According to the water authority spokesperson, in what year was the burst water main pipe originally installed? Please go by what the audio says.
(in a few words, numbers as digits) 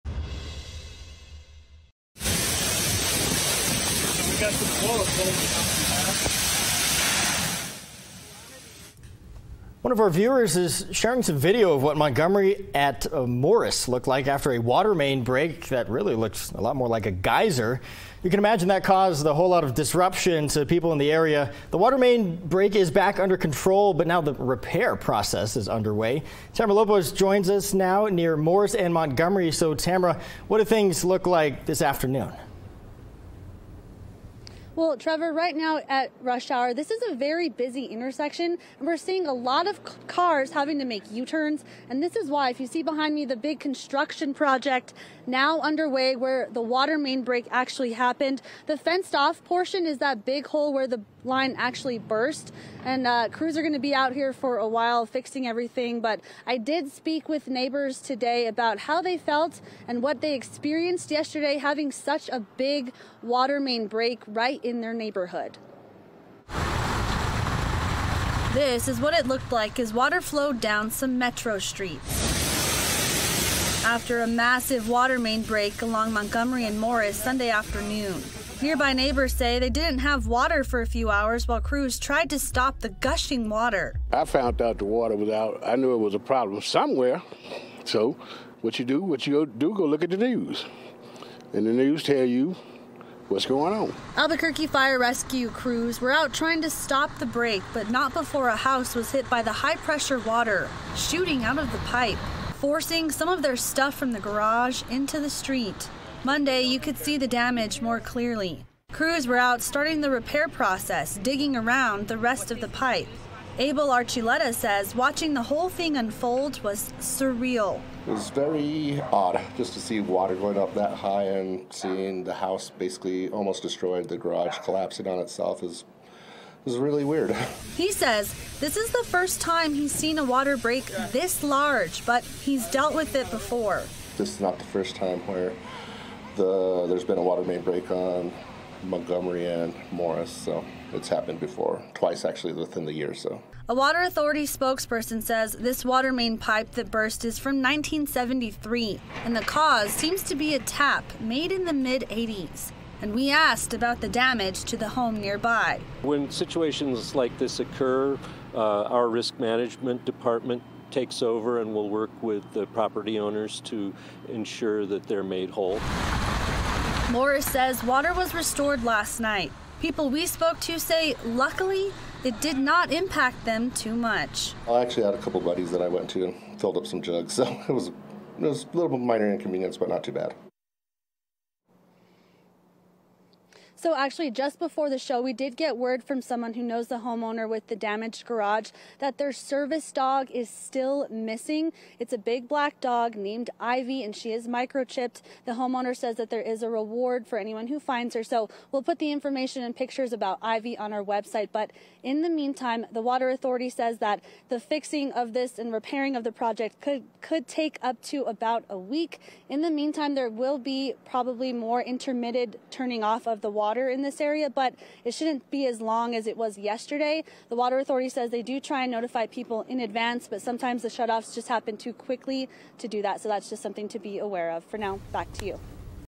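1973.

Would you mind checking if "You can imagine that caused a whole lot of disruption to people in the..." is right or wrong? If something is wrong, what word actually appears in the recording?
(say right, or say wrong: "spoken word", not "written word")
right.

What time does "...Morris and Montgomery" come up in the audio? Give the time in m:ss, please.
0:28.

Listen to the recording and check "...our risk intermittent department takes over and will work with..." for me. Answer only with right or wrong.
wrong.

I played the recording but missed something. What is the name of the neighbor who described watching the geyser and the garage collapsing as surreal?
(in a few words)
Abel Archuleta.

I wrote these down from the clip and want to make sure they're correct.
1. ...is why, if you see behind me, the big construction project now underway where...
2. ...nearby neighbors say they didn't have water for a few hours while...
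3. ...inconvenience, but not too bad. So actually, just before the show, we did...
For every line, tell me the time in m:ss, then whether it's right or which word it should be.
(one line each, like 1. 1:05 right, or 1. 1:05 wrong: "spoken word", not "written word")
1. 0:42 right
2. 1:18 right
3. 2:59 right.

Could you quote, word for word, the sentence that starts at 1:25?
I knew it was a problem somewhere.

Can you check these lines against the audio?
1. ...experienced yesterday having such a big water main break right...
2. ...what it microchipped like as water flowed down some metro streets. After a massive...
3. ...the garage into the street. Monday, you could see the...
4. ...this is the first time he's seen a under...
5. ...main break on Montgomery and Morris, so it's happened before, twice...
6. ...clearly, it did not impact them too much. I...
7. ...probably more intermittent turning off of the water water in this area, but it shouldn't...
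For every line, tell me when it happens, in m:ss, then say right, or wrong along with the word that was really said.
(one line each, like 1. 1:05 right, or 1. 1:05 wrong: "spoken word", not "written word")
1. 1:00 right
2. 1:08 wrong: "looked", not "microchipped"
3. 1:44 right
4. 2:08 wrong: "water", not "under"
5. 2:17 right
6. 2:51 wrong: "luckily", not "clearly"
7. 3:31 right.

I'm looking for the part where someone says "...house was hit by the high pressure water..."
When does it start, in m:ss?
1:38.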